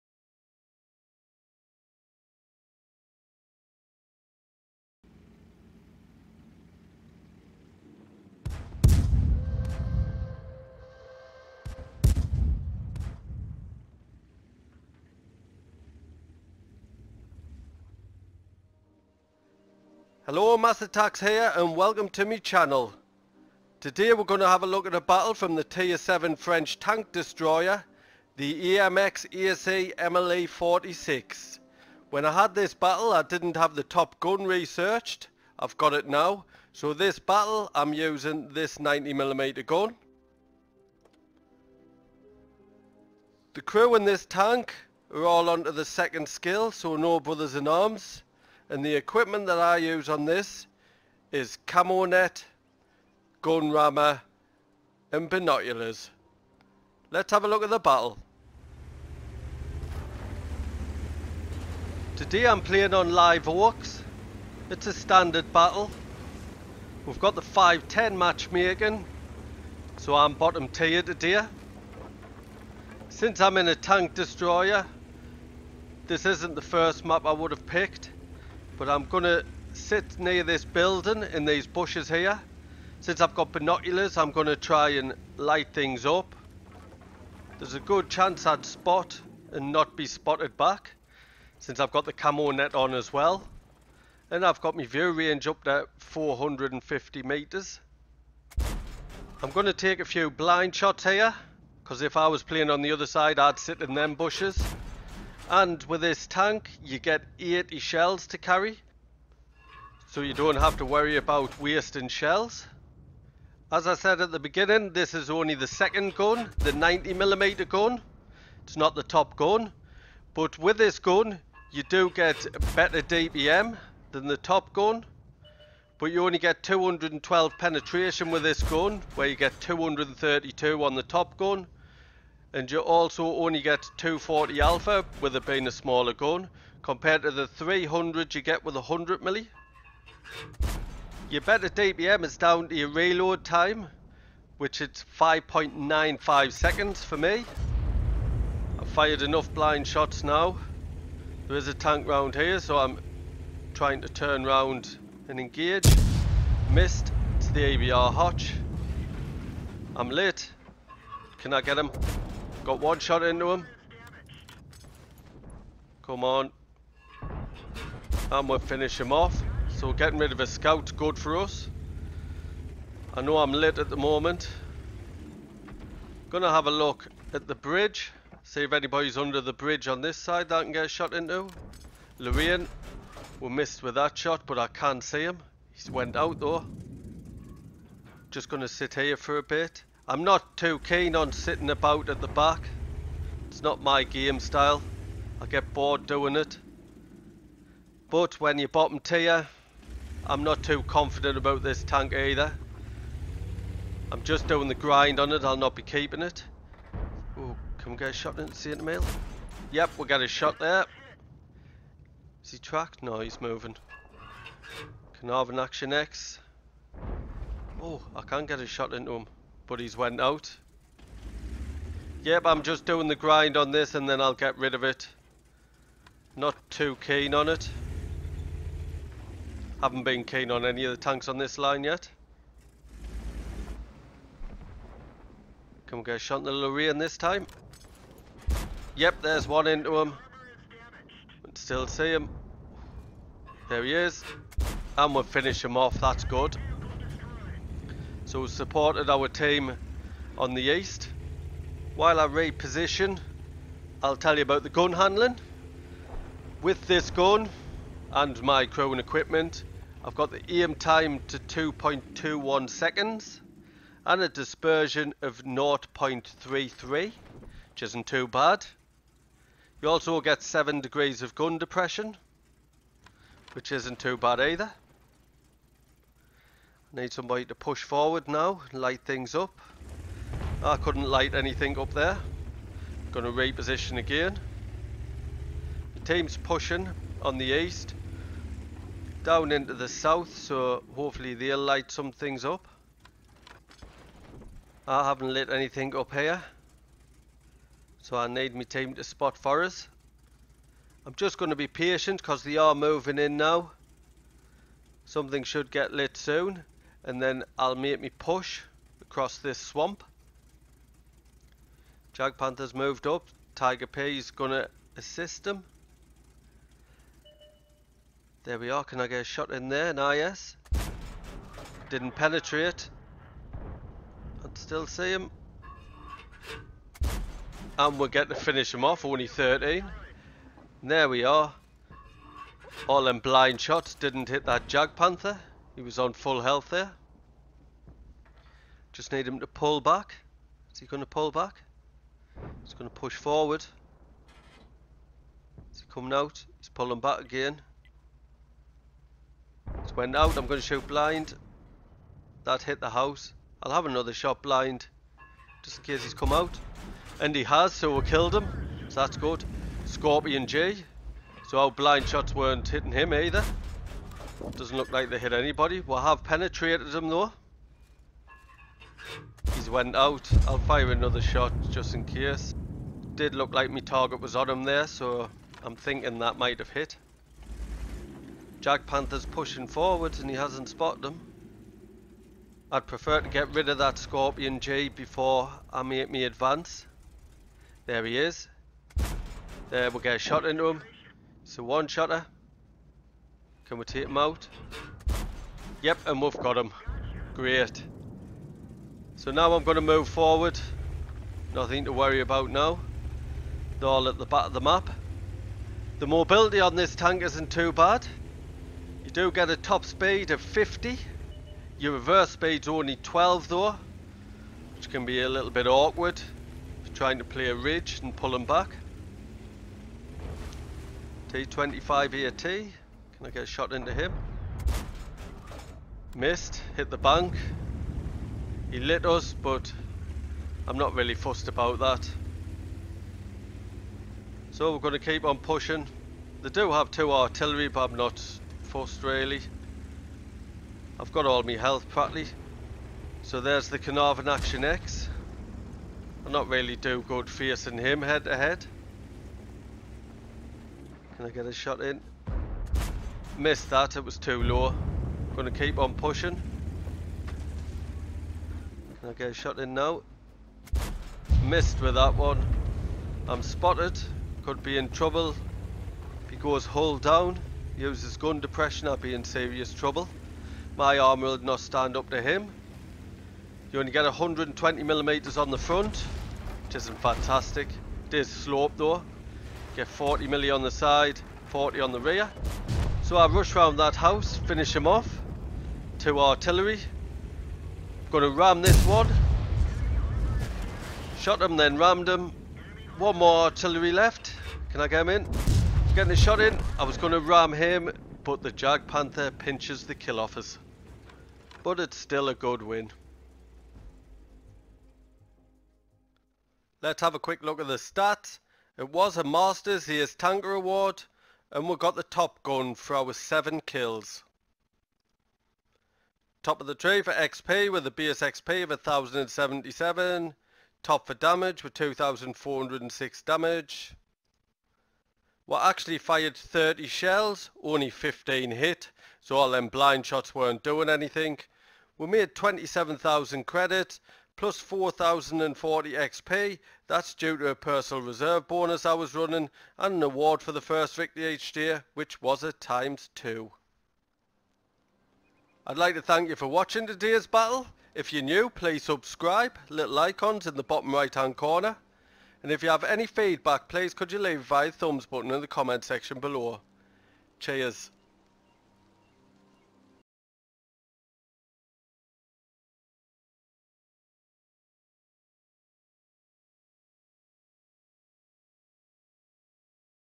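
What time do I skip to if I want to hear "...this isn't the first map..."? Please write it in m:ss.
1:16.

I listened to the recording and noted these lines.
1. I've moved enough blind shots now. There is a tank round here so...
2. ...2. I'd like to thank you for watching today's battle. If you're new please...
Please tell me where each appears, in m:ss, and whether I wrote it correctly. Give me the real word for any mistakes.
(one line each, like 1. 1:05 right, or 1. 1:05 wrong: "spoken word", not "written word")
1. 2:28 wrong: "fired", not "moved"
2. 9:03 right.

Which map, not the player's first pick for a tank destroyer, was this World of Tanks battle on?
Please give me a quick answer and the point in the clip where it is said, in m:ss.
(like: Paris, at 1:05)
Live Oaks, at 1:03.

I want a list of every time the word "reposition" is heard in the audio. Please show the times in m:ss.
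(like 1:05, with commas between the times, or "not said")
4:12, 4:43.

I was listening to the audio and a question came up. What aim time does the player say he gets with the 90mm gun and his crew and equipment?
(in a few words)
2.21 seconds.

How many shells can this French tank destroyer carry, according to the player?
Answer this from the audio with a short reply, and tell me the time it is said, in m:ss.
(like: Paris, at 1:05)
80, at 1:47.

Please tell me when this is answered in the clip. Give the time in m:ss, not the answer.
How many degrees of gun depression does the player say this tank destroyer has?
4:30.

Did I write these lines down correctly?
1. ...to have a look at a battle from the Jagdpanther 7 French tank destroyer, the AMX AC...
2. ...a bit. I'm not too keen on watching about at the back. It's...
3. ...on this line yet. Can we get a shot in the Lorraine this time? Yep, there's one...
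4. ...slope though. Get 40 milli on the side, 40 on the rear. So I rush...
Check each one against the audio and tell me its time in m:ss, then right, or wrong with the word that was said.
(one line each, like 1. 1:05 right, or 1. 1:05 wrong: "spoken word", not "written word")
1. 0:24 wrong: "Tier", not "Jagdpanther"
2. 3:09 wrong: "sitting", not "watching"
3. 3:51 right
4. 7:58 right.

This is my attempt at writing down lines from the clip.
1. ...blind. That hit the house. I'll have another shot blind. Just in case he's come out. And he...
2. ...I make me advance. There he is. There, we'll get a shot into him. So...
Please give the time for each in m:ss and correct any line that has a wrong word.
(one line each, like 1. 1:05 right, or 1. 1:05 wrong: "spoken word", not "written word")
1. 5:50 right
2. 6:25 right.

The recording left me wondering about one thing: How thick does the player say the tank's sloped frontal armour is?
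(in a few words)
120 millimeters.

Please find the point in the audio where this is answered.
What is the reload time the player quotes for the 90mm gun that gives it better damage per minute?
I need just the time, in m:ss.
2:25.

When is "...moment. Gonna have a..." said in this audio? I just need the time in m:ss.
2:53.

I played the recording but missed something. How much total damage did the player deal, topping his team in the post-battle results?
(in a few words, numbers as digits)
2406.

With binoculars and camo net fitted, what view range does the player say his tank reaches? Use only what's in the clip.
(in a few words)
450 metres.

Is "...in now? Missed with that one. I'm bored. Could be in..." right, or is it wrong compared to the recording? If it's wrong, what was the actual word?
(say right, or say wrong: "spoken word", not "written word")
wrong: "spotted", not "bored".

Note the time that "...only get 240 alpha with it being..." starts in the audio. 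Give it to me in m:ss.
2:13.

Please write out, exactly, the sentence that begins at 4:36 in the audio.
Need somebody to push forward now, light things up.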